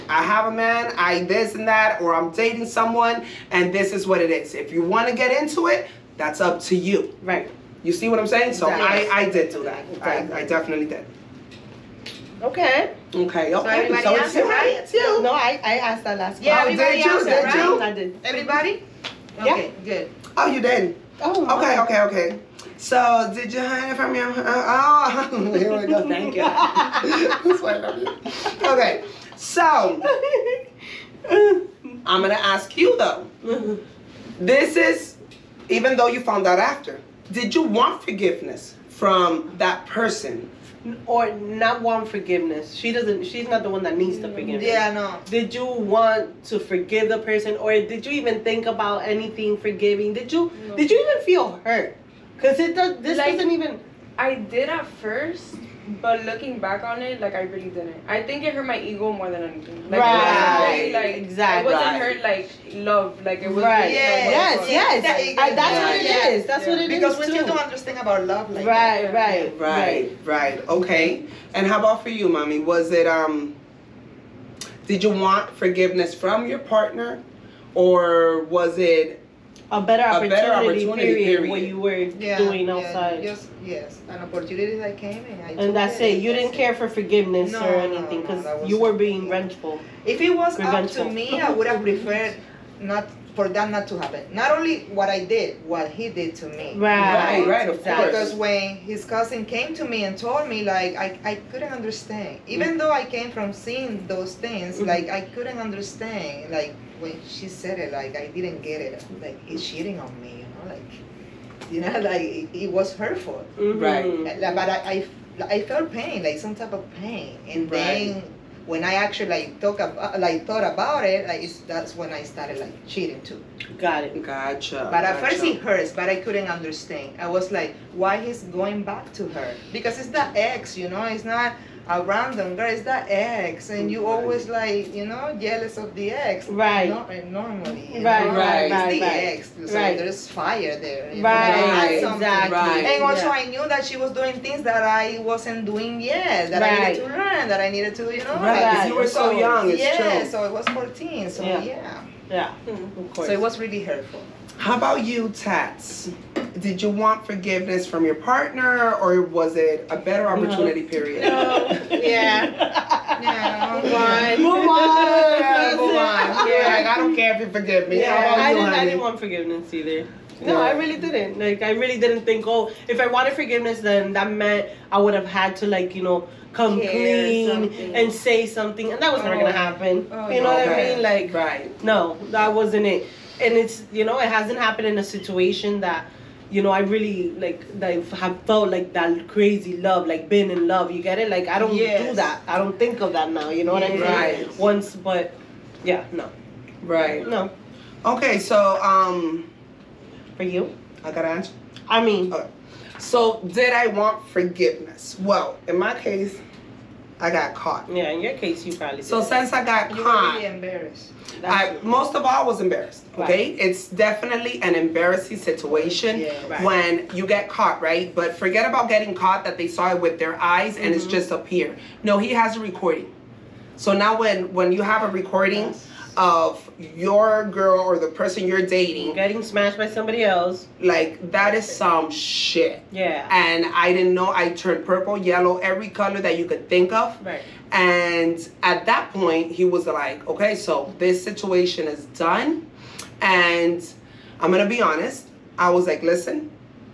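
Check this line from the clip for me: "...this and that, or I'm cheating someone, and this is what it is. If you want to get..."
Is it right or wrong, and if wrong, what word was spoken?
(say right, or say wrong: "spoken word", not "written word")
wrong: "dating", not "cheating".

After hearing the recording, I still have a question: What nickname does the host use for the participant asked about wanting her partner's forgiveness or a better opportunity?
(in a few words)
Mommy.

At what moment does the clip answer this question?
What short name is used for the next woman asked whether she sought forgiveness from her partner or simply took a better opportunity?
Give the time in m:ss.
2:35.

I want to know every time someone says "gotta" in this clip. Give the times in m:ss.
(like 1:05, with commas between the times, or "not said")
3:21.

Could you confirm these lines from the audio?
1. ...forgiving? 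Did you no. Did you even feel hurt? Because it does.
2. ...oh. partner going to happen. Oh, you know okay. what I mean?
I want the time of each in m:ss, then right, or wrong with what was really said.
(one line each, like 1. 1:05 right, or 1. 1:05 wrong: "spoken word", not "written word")
1. 0:49 right
2. 2:59 wrong: "never", not "partner".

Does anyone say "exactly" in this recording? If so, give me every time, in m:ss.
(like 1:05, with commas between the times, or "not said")
0:09, 1:01, 2:22.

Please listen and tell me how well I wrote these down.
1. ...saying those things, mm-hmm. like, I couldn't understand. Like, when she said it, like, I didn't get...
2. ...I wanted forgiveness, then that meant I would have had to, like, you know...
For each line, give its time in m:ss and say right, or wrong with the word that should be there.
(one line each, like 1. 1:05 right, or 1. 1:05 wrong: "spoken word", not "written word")
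1. 1:43 wrong: "seeing", not "saying"
2. 2:52 right.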